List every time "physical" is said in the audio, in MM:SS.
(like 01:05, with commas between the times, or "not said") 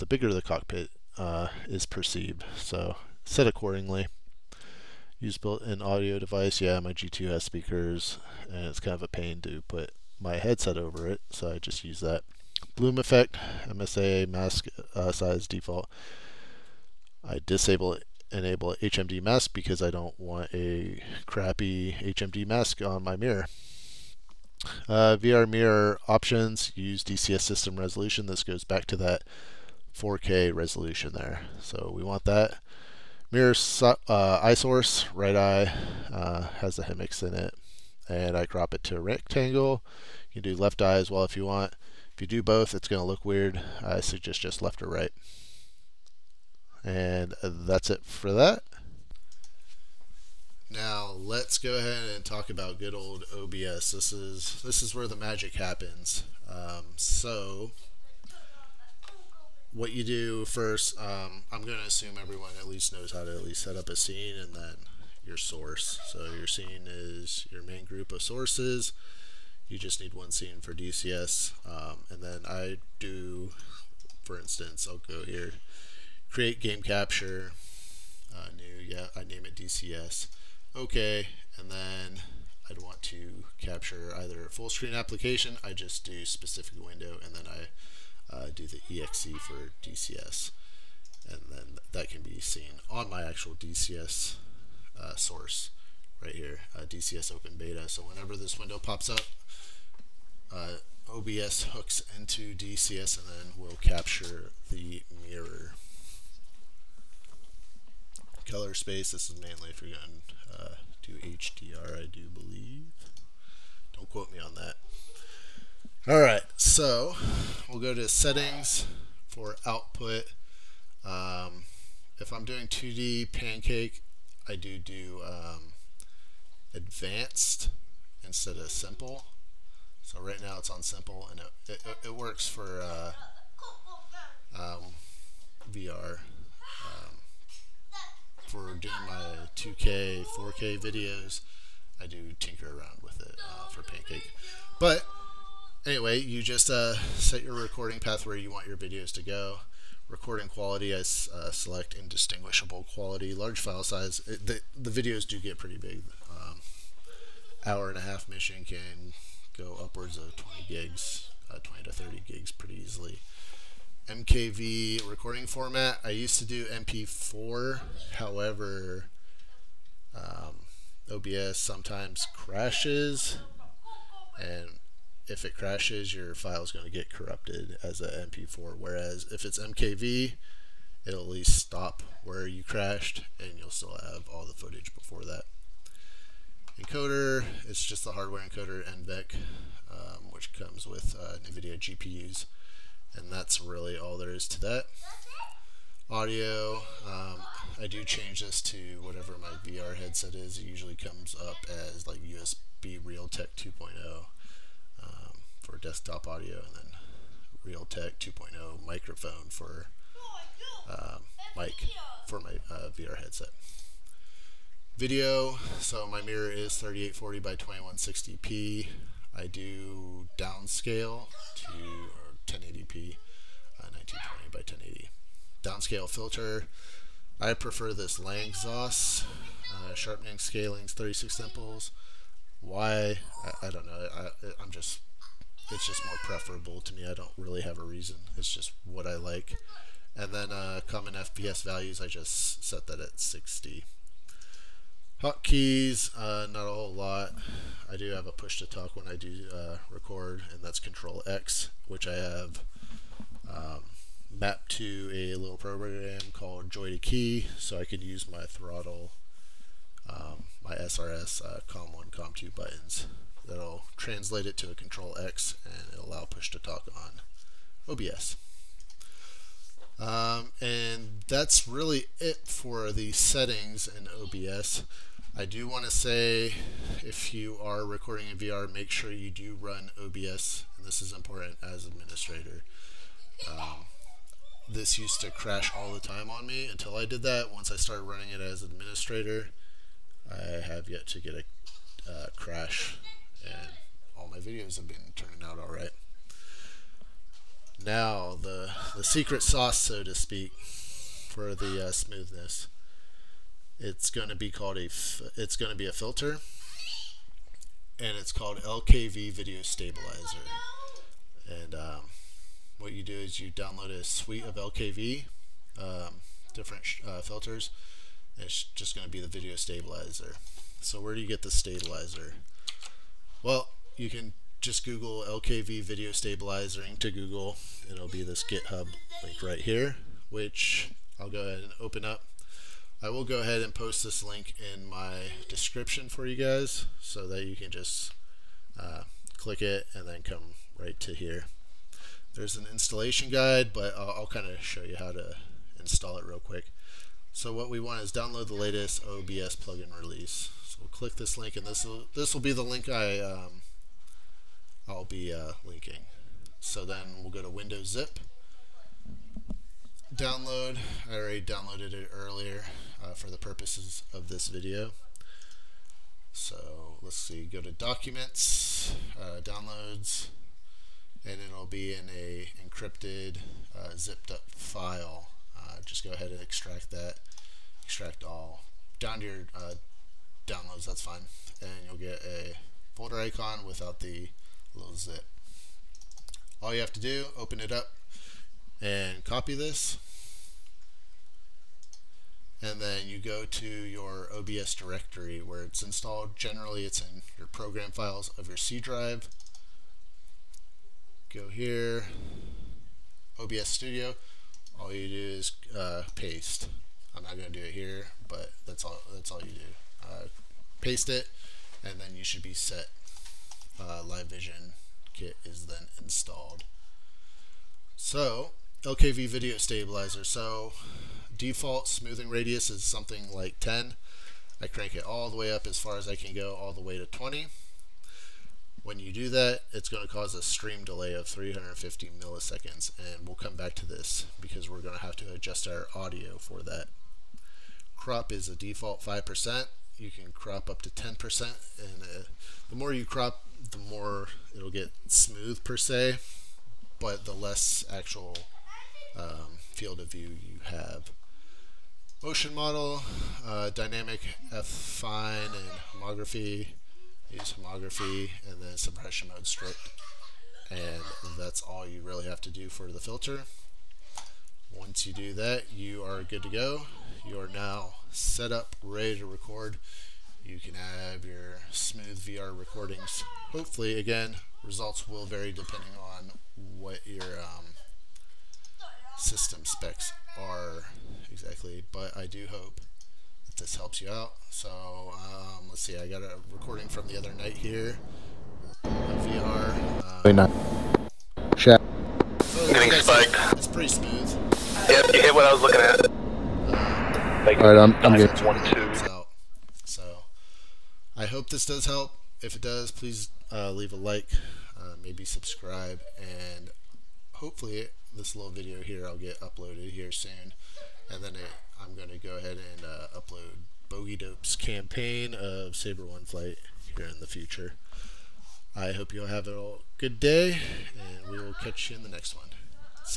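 not said.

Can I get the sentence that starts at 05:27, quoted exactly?
It'll be this GitHub link right here, which I'll go ahead and open up.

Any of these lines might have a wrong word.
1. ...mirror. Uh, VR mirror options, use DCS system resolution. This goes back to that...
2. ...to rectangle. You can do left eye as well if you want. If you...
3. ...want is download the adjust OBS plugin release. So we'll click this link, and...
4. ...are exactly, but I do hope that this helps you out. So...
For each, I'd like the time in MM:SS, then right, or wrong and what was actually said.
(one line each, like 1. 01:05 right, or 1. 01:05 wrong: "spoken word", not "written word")
1. 00:23 right
2. 00:38 right
3. 05:47 wrong: "latest", not "adjust"
4. 08:00 right.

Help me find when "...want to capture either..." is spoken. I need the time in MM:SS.
01:22.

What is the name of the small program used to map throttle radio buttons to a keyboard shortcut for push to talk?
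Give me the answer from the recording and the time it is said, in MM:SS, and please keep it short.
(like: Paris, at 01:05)
JoyToKey, at 04:16.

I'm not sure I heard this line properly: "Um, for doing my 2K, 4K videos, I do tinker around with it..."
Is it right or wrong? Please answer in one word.
right.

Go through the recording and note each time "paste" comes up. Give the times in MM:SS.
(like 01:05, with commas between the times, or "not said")
06:46, 06:50.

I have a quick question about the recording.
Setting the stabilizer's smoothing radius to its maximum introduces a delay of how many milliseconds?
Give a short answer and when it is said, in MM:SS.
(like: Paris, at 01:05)
350, at 07:11.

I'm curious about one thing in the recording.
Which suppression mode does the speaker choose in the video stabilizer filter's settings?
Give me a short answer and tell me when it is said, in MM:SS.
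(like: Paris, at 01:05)
Strict, at 07:39.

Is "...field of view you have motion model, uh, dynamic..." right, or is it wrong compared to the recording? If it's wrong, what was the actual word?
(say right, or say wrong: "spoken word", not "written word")
right.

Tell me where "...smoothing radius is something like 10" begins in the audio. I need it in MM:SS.
07:01.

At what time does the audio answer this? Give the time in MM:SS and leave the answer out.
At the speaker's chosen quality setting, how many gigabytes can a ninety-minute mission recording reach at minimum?
02:40.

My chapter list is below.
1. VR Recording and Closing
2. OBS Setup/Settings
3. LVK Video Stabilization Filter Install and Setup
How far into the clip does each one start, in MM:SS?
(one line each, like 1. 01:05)
1. 08:00
2. 00:50
3. 05:00.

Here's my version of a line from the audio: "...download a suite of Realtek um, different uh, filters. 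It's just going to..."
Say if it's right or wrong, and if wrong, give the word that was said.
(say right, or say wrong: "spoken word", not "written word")
wrong: "LKV", not "Realtek".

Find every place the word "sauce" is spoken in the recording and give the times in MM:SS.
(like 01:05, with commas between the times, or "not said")
04:59.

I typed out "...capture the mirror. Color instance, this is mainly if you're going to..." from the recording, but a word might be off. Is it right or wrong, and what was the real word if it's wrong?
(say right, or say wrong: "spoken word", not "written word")
wrong: "space", not "instance".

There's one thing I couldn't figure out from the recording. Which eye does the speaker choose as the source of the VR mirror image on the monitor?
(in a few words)
Right eye.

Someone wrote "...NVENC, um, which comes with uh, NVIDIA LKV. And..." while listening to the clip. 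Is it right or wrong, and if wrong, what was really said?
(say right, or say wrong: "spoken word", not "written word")
wrong: "GPUs", not "LKV".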